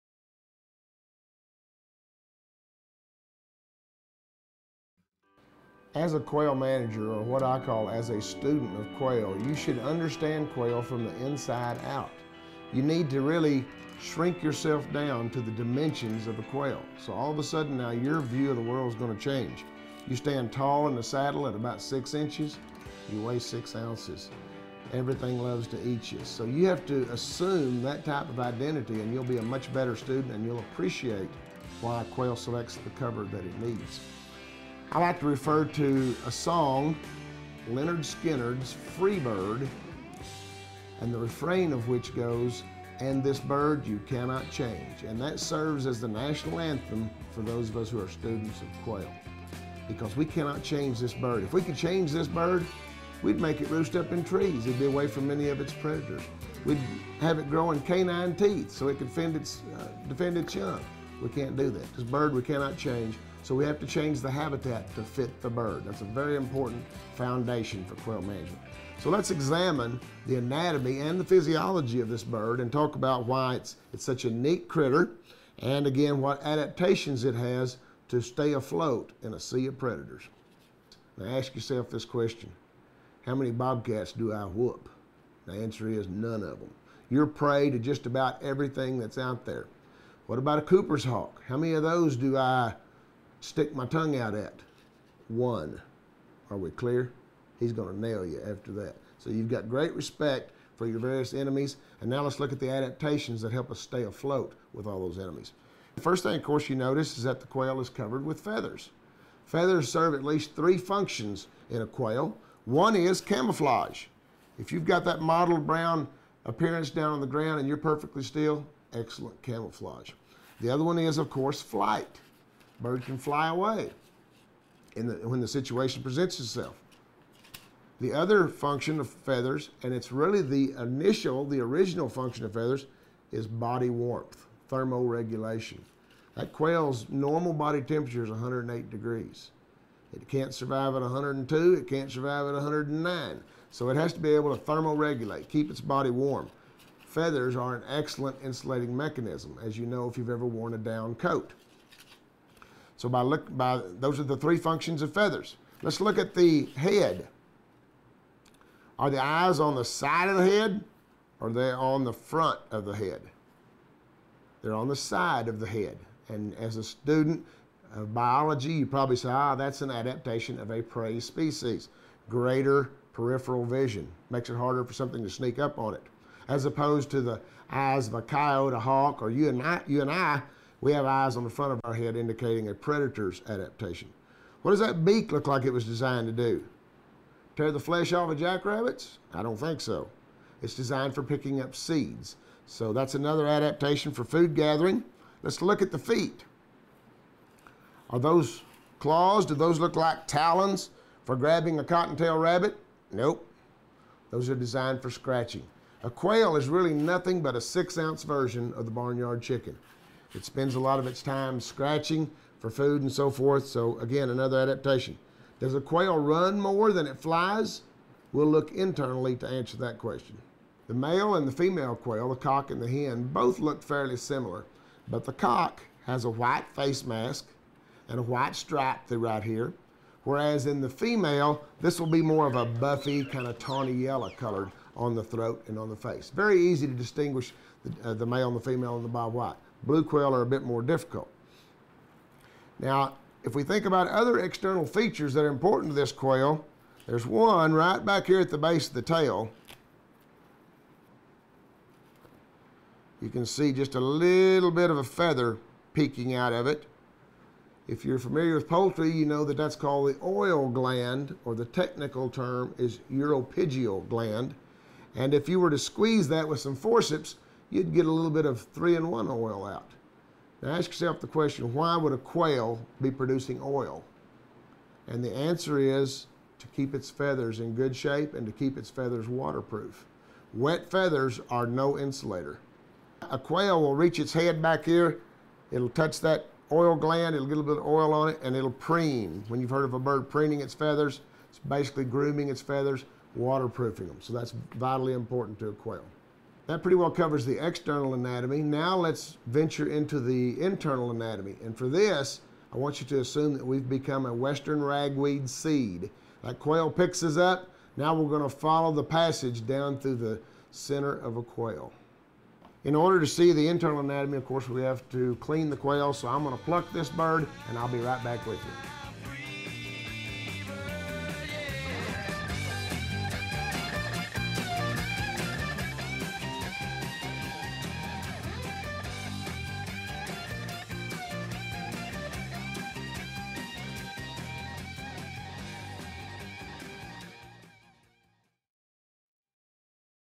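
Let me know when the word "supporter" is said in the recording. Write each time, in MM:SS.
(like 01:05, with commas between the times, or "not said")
not said.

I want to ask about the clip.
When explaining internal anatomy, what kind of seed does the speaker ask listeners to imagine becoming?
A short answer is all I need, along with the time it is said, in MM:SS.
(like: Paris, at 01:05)
western ragweed seed, at 05:04.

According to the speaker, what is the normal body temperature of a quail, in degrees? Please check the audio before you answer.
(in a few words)
108.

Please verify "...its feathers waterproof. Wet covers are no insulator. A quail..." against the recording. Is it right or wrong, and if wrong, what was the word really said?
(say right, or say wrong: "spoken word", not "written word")
wrong: "feathers", not "covers".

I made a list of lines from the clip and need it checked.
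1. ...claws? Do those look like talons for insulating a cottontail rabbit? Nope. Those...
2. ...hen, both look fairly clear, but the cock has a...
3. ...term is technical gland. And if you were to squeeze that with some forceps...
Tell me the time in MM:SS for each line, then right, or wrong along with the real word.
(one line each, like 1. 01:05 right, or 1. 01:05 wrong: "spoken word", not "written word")
1. 03:18 wrong: "grabbing", not "insulating"
2. 03:42 wrong: "similar", not "clear"
3. 04:22 wrong: "uropygial", not "technical".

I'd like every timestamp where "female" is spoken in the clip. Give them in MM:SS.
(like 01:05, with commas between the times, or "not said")
03:41, 03:50, 03:58.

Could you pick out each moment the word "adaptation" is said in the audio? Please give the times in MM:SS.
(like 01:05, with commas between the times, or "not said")
01:16, 01:42, 02:49, 03:03, 03:13, 03:34.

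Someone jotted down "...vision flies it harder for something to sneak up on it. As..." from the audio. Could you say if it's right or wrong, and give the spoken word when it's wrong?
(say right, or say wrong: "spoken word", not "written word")
wrong: "makes", not "flies".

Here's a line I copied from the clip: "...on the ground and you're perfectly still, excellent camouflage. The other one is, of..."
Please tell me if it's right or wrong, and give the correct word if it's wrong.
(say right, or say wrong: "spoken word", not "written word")
right.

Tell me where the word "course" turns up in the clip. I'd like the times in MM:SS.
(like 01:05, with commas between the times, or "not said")
01:46, 02:01, 05:14.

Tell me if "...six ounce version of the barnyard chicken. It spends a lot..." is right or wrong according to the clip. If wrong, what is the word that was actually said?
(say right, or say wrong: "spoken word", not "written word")
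right.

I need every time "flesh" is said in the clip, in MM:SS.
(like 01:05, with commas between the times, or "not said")
03:07.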